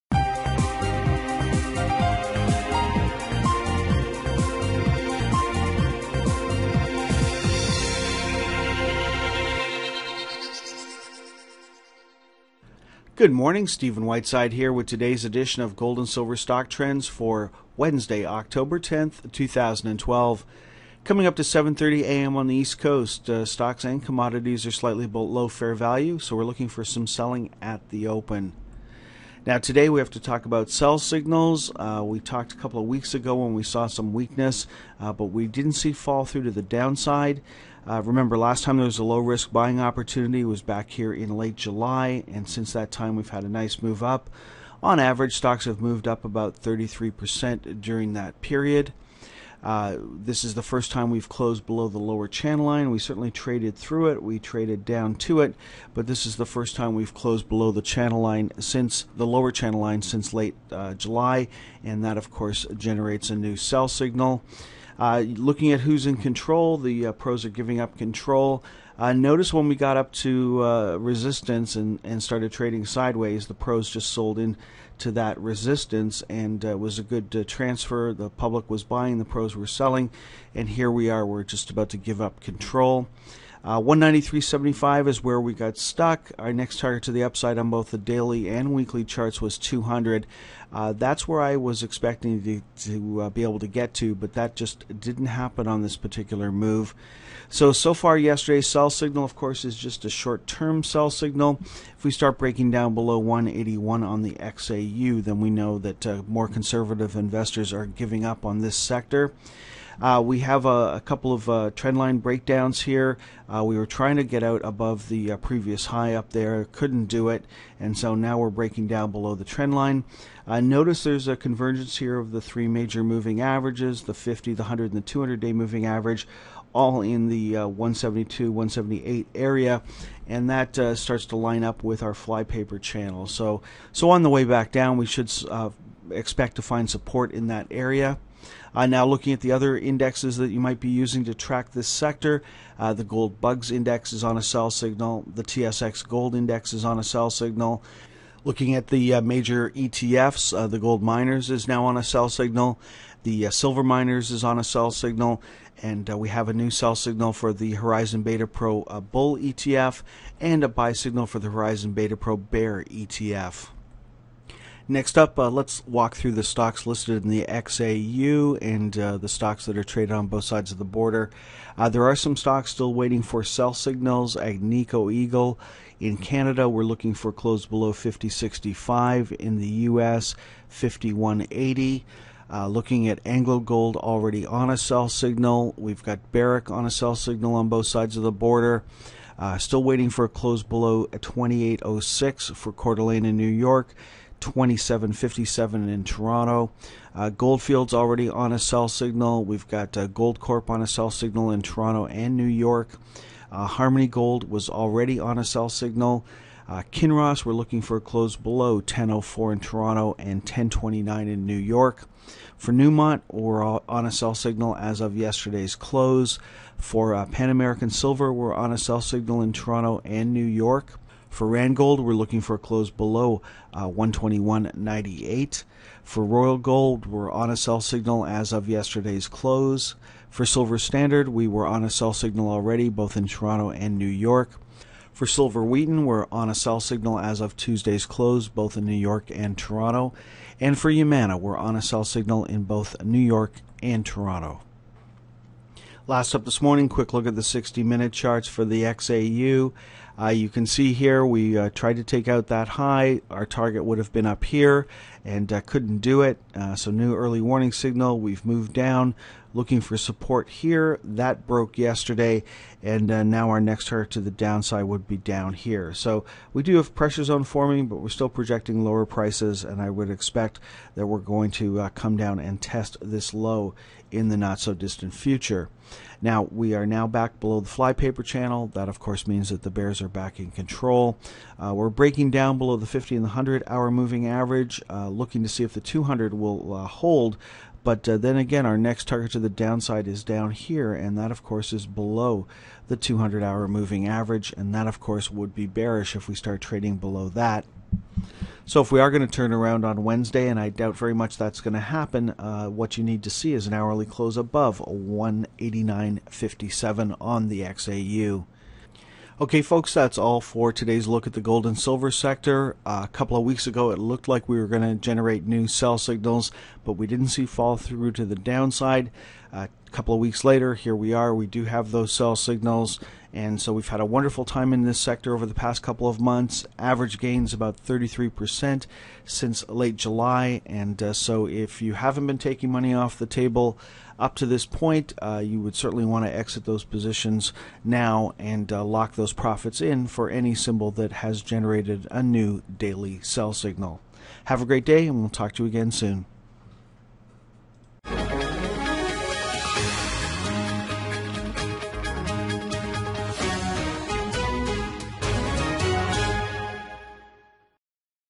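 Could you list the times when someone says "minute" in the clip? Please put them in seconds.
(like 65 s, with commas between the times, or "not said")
247 s.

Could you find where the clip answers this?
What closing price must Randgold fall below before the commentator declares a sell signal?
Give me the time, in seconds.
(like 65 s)
223 s.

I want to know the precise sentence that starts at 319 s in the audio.
Uh, couple of weeks later, here we are.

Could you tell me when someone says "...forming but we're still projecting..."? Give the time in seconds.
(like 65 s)
267 s.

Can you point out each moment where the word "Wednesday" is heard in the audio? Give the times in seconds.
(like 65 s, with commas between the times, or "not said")
17 s, 300 s.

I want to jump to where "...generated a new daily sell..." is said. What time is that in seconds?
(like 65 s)
341 s.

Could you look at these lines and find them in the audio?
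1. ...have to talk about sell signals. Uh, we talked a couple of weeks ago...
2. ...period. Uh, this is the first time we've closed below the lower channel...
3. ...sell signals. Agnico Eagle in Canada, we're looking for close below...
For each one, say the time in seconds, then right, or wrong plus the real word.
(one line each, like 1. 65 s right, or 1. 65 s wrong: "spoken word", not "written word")
1. 29 s right
2. 48 s right
3. 173 s right.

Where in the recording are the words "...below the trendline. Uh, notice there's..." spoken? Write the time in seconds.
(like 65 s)
119 s.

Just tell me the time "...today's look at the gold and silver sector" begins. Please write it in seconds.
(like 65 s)
310 s.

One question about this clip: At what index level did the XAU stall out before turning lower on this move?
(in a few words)
193.75.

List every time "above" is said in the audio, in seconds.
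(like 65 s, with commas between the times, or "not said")
114 s, 304 s.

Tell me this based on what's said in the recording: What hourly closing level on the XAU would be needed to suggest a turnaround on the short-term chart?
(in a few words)
189.57.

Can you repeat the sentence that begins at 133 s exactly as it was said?
So, so on the way back down, we should uh, expect to find support in that area.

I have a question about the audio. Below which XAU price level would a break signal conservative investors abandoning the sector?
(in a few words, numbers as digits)
181.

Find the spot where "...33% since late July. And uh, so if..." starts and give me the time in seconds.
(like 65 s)
327 s.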